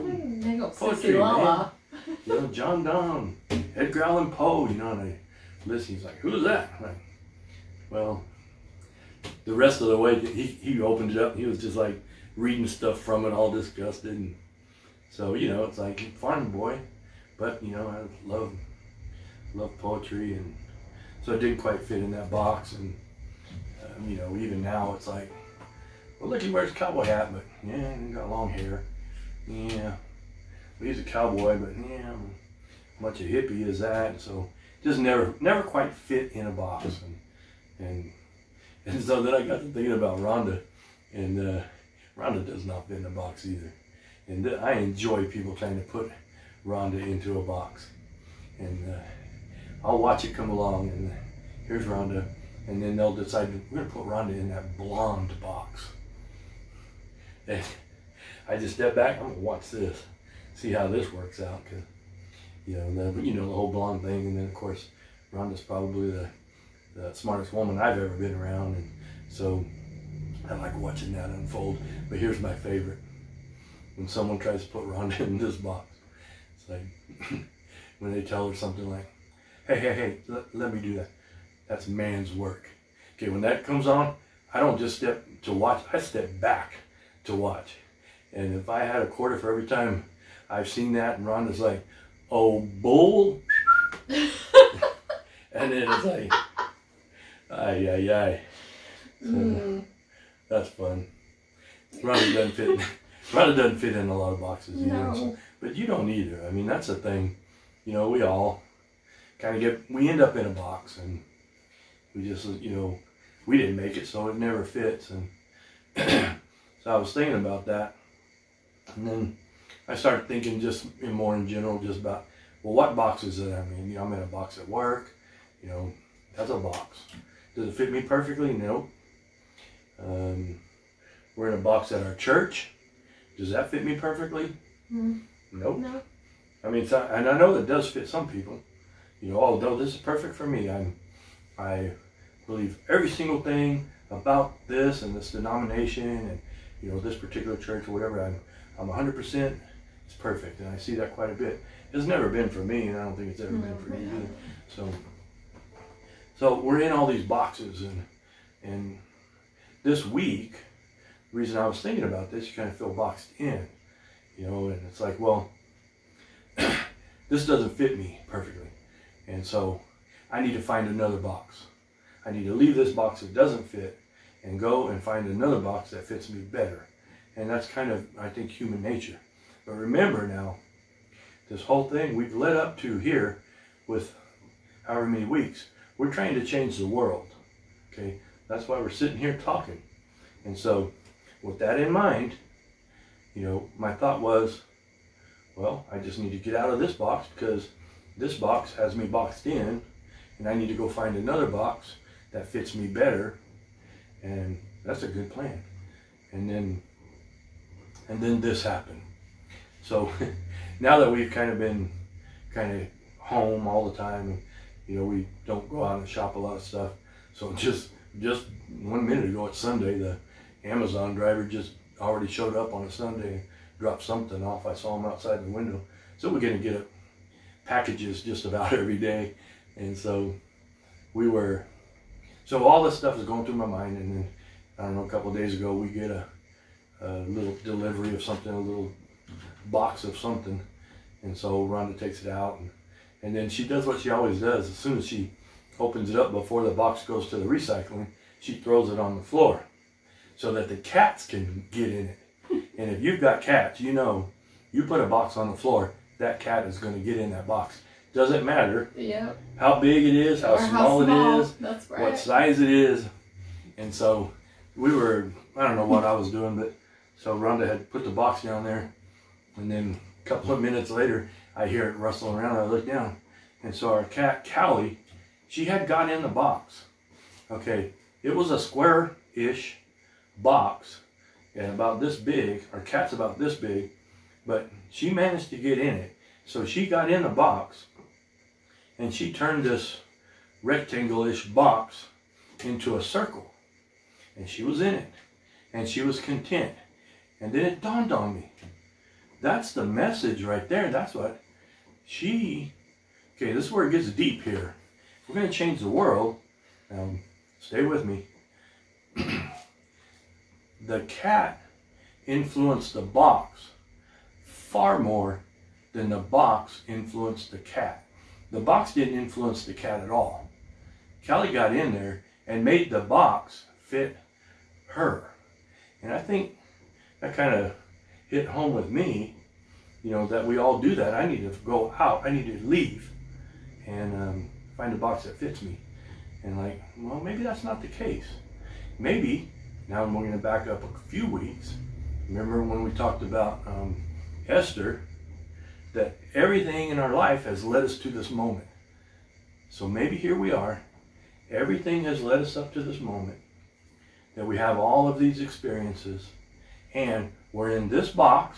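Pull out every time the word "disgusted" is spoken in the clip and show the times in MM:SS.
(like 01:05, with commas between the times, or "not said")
00:13.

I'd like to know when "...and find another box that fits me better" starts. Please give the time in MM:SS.
02:54.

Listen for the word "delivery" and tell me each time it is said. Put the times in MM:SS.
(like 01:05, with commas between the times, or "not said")
03:57.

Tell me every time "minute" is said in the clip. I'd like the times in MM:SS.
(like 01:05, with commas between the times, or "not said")
03:39, 04:30.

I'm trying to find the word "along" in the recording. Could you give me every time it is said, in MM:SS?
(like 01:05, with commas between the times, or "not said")
00:50.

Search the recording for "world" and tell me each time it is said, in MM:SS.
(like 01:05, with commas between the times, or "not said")
03:06, 05:05.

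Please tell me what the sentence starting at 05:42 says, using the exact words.
Remember when we talked about um, Esther that everything in our life has led us to this moment.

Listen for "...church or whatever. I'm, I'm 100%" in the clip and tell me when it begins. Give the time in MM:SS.
02:27.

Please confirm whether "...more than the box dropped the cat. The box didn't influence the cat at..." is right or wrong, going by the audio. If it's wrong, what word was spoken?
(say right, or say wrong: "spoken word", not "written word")
wrong: "influenced", not "dropped".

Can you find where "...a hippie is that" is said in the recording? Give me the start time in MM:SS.
00:33.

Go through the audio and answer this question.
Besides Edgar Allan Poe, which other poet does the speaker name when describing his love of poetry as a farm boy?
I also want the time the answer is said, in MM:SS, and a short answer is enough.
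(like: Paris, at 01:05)
John Donne, at 00:02.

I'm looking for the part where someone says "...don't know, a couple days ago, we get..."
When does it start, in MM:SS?
03:54.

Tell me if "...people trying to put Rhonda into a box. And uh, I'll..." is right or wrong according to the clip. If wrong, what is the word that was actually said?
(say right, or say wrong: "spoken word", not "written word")
right.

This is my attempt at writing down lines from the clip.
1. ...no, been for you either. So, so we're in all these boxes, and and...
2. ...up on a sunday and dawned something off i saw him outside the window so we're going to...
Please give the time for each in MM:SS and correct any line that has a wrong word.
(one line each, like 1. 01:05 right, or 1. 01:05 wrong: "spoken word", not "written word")
1. 02:33 right
2. 03:42 wrong: "dropped", not "dawned".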